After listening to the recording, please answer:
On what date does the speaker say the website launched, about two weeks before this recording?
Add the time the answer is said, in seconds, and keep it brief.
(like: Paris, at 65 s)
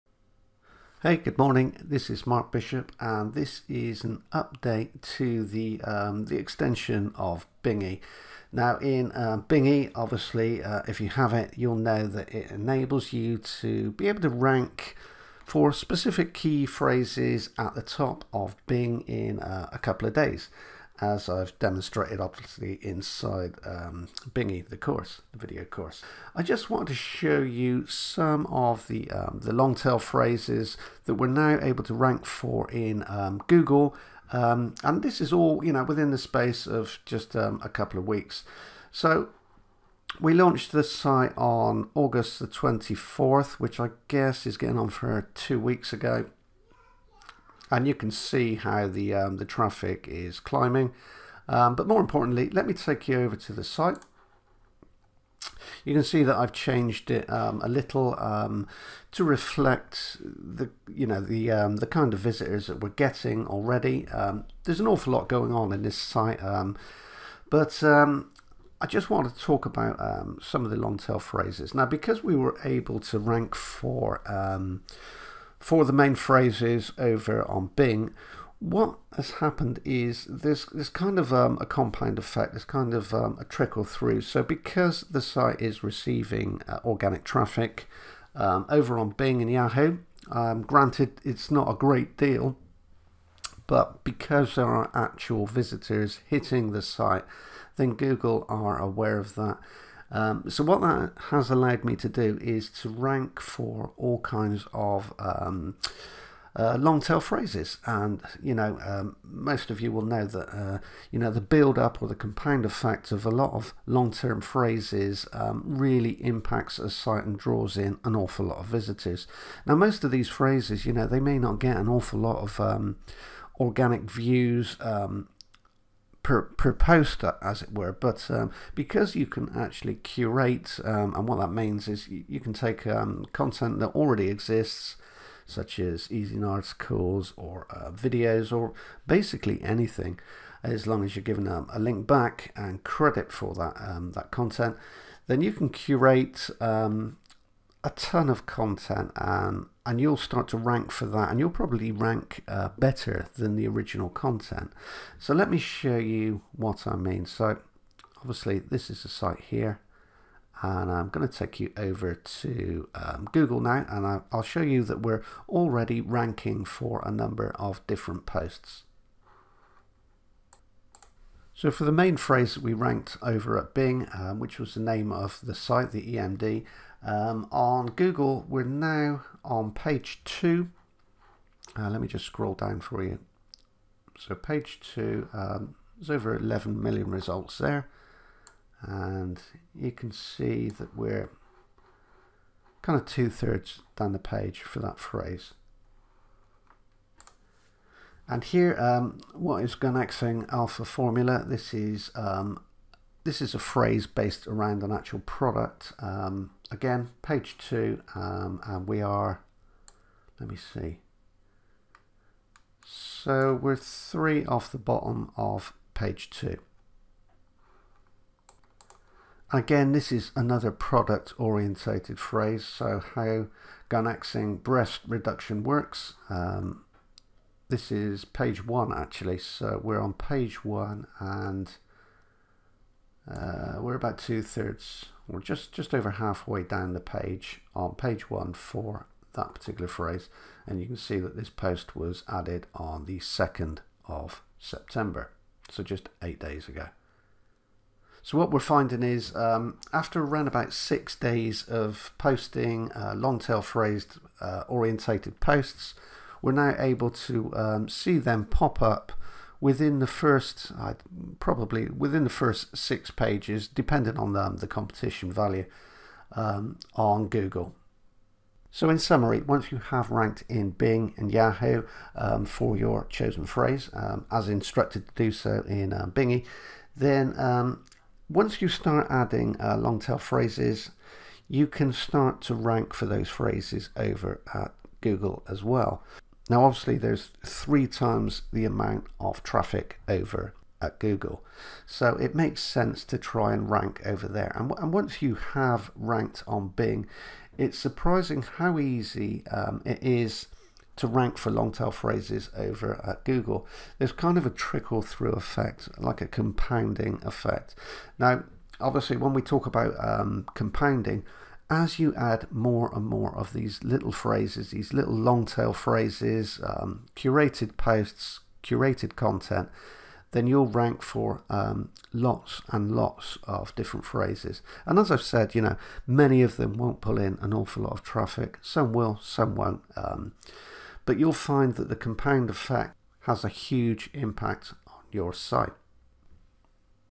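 August 24, at 41 s.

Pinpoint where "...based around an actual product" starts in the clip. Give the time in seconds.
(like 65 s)
204 s.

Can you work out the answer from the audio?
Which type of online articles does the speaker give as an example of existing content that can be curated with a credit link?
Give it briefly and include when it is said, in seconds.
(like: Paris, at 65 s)
Ezine Articles, at 136 s.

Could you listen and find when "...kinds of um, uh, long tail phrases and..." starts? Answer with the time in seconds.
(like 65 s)
104 s.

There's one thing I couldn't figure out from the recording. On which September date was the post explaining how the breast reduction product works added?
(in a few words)
2nd of September.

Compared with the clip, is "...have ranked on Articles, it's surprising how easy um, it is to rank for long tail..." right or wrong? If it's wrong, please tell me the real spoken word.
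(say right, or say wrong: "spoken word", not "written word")
wrong: "Bing", not "Articles".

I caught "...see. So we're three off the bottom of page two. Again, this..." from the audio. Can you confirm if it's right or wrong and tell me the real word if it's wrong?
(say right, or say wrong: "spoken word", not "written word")
right.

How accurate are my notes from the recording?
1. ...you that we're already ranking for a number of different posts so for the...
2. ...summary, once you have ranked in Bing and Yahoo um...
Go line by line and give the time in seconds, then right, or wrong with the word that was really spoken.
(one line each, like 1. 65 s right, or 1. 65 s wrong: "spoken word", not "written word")
1. 164 s right
2. 268 s right.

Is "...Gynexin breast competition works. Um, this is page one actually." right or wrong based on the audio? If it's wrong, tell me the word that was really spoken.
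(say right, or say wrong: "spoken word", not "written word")
wrong: "reduction", not "competition".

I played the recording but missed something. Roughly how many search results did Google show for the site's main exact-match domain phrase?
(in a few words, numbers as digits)
Over 11 million.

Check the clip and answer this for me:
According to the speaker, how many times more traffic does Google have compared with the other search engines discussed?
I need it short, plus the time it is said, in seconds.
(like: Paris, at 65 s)
3, at 287 s.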